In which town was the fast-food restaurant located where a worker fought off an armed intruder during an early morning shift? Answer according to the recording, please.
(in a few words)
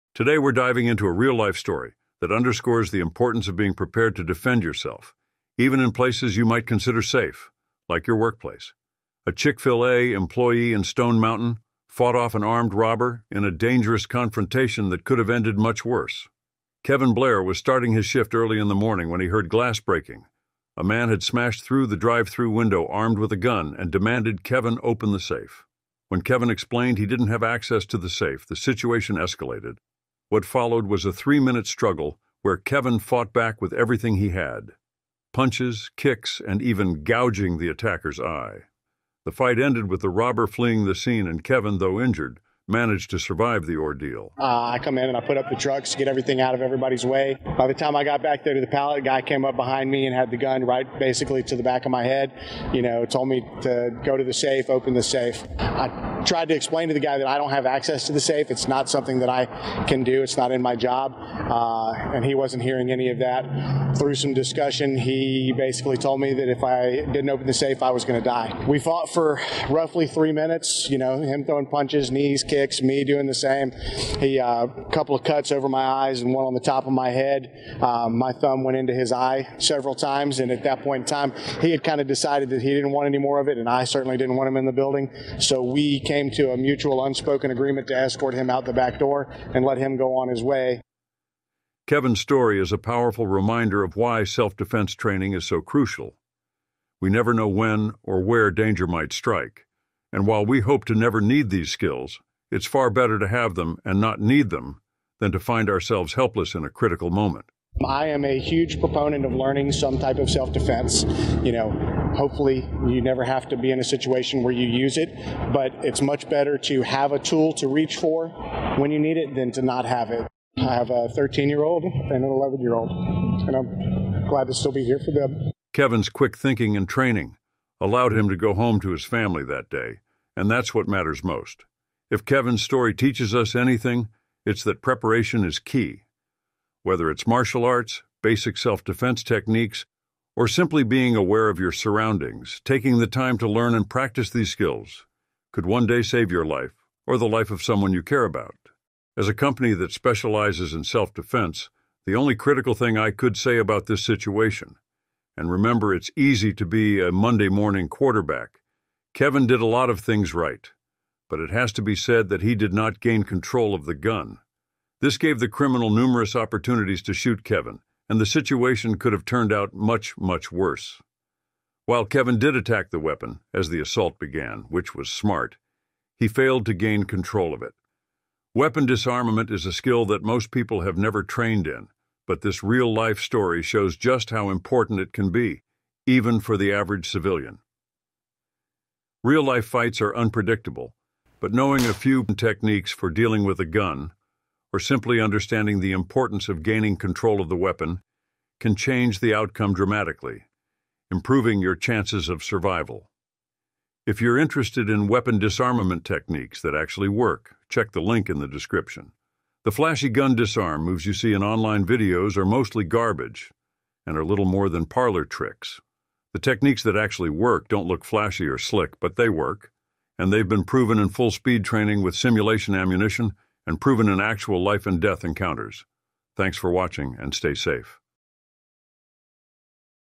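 Stone Mountain.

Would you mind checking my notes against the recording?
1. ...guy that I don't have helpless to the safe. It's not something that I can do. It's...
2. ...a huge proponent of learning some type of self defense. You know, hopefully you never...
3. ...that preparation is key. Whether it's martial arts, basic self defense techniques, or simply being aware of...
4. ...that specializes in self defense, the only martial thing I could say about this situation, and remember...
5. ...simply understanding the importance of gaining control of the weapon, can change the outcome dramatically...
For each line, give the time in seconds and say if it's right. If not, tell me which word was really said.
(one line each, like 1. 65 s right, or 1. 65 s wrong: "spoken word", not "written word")
1. 56 s wrong: "access", not "helpless"
2. 108 s right
3. 134 s right
4. 149 s wrong: "critical", not "martial"
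5. 194 s right.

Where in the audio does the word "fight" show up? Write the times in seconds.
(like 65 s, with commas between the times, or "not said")
39 s, 189 s.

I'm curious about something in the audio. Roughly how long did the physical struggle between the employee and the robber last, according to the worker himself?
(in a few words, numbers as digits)
3 minutes.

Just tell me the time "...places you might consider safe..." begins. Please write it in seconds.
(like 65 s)
5 s.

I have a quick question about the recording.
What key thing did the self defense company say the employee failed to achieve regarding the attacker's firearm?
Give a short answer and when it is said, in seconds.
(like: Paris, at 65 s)
control of the gun, at 163 s.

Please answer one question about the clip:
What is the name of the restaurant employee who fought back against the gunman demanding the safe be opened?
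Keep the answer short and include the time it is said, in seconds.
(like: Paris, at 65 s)
Kevin Blair, at 16 s.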